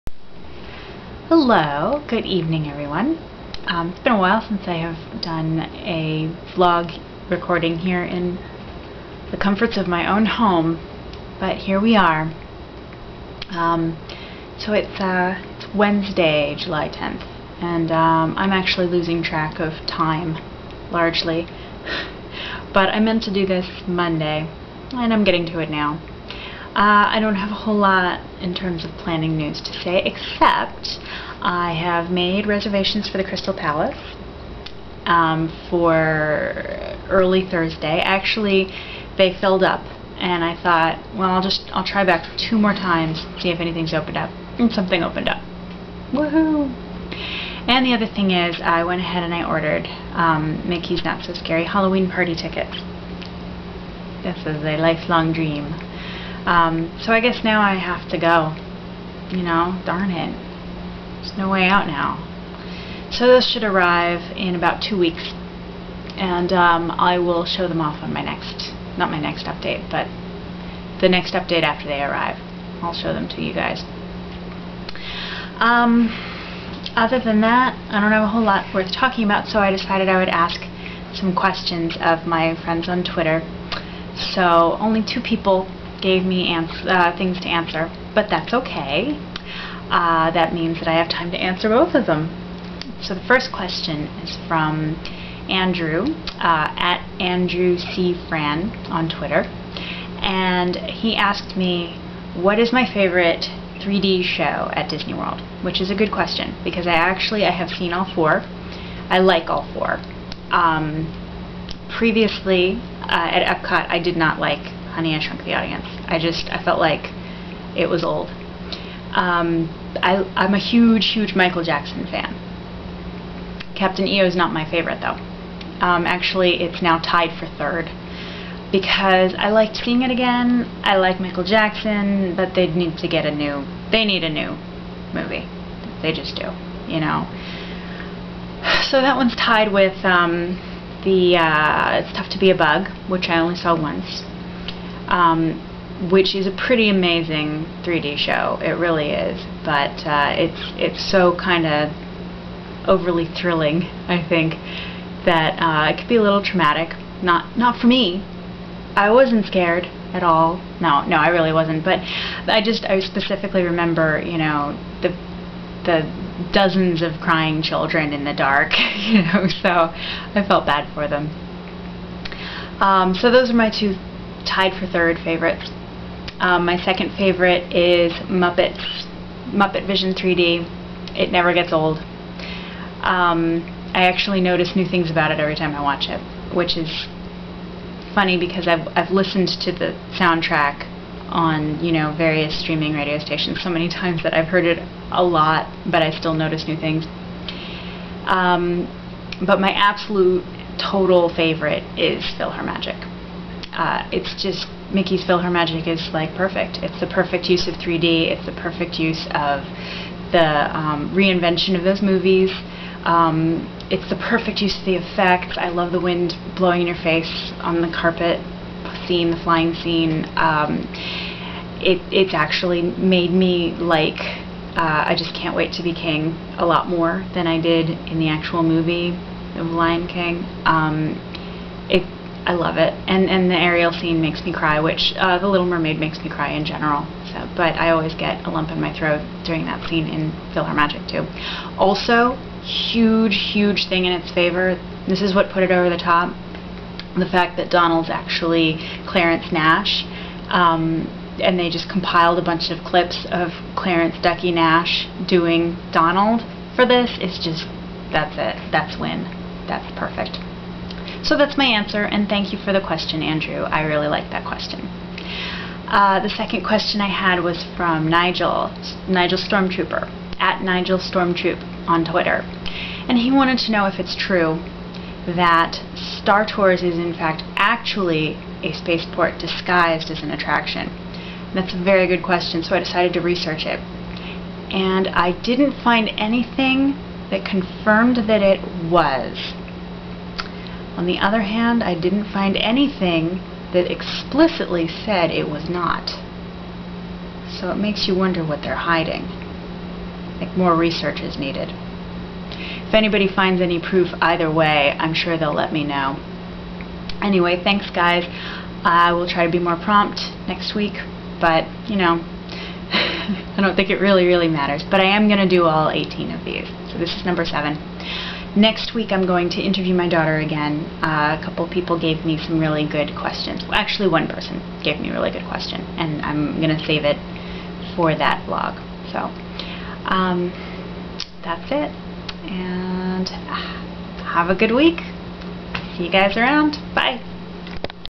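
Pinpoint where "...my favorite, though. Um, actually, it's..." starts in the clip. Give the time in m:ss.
2:04.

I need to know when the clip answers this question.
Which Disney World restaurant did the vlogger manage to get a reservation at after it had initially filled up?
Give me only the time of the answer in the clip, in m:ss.
0:33.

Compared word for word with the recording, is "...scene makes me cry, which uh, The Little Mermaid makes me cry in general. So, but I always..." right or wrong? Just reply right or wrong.
right.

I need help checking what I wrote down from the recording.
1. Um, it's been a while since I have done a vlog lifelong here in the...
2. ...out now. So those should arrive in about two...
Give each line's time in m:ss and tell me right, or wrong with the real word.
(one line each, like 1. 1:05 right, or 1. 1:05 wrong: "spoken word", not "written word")
1. 0:03 wrong: "recording", not "lifelong"
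2. 1:01 right.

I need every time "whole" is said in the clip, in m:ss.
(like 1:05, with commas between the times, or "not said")
0:27, 1:18.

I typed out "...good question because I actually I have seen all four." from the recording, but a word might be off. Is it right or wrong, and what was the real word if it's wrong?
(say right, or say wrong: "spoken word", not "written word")
right.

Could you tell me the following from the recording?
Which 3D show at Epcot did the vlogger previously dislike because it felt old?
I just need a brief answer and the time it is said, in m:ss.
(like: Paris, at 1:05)
Honey, I Shrunk the Audience, at 1:54.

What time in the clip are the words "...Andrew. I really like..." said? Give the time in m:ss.
4:23.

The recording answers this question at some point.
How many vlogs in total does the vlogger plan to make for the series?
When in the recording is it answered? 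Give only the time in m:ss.
5:15.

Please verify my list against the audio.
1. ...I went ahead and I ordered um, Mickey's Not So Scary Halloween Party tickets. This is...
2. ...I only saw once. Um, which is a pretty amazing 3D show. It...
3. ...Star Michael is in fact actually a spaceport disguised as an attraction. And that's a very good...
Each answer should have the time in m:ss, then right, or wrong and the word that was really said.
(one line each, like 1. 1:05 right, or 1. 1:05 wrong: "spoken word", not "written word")
1. 0:48 right
2. 2:23 right
3. 4:35 wrong: "Tours", not "Michael".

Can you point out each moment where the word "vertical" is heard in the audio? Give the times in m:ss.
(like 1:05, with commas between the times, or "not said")
not said.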